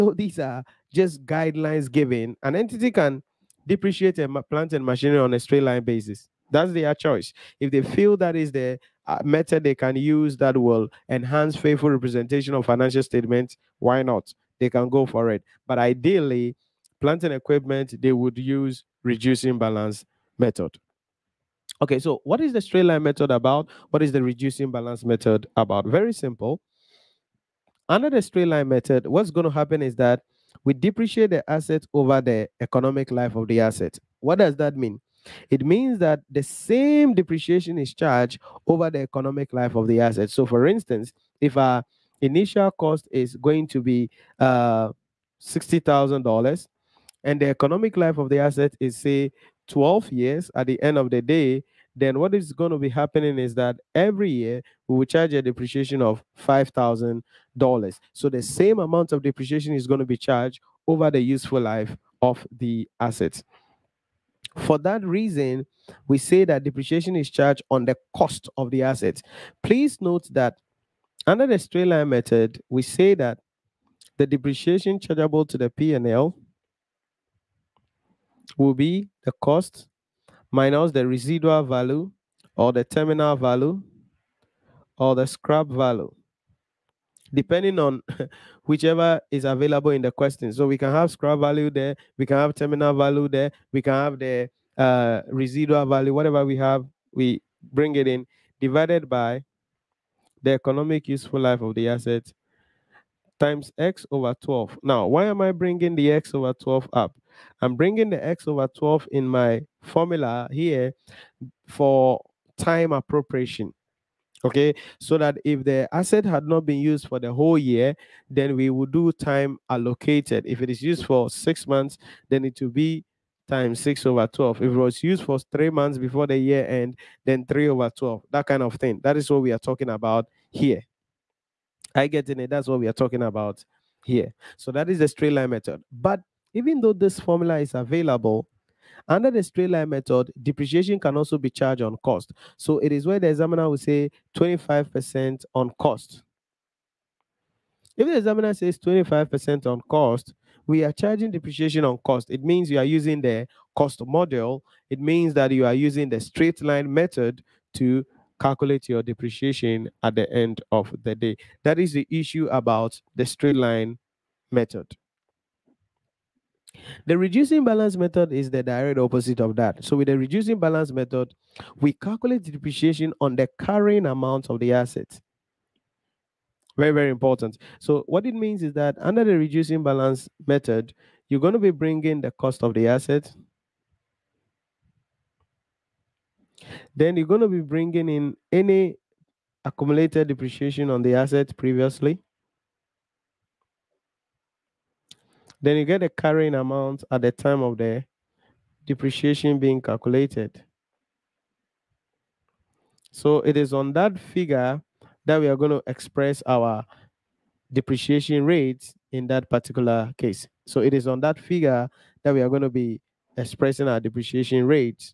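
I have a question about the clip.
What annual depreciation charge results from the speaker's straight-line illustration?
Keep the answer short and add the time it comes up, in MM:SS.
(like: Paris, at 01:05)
$5,000, at 00:56.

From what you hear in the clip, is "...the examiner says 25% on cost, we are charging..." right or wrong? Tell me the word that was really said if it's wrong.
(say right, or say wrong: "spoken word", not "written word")
right.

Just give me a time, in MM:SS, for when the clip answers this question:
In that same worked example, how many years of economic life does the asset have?
00:49.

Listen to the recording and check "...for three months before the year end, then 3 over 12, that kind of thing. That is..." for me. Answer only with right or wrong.
right.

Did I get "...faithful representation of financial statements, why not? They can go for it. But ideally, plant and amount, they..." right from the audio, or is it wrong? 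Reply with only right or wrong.
wrong.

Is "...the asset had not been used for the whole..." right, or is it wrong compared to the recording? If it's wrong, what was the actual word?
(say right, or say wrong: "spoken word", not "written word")
right.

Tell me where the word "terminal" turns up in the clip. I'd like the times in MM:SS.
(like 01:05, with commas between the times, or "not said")
01:22, 01:32.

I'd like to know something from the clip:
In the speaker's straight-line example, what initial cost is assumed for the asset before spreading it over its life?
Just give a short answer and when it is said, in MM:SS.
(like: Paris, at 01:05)
$60,000, at 00:45.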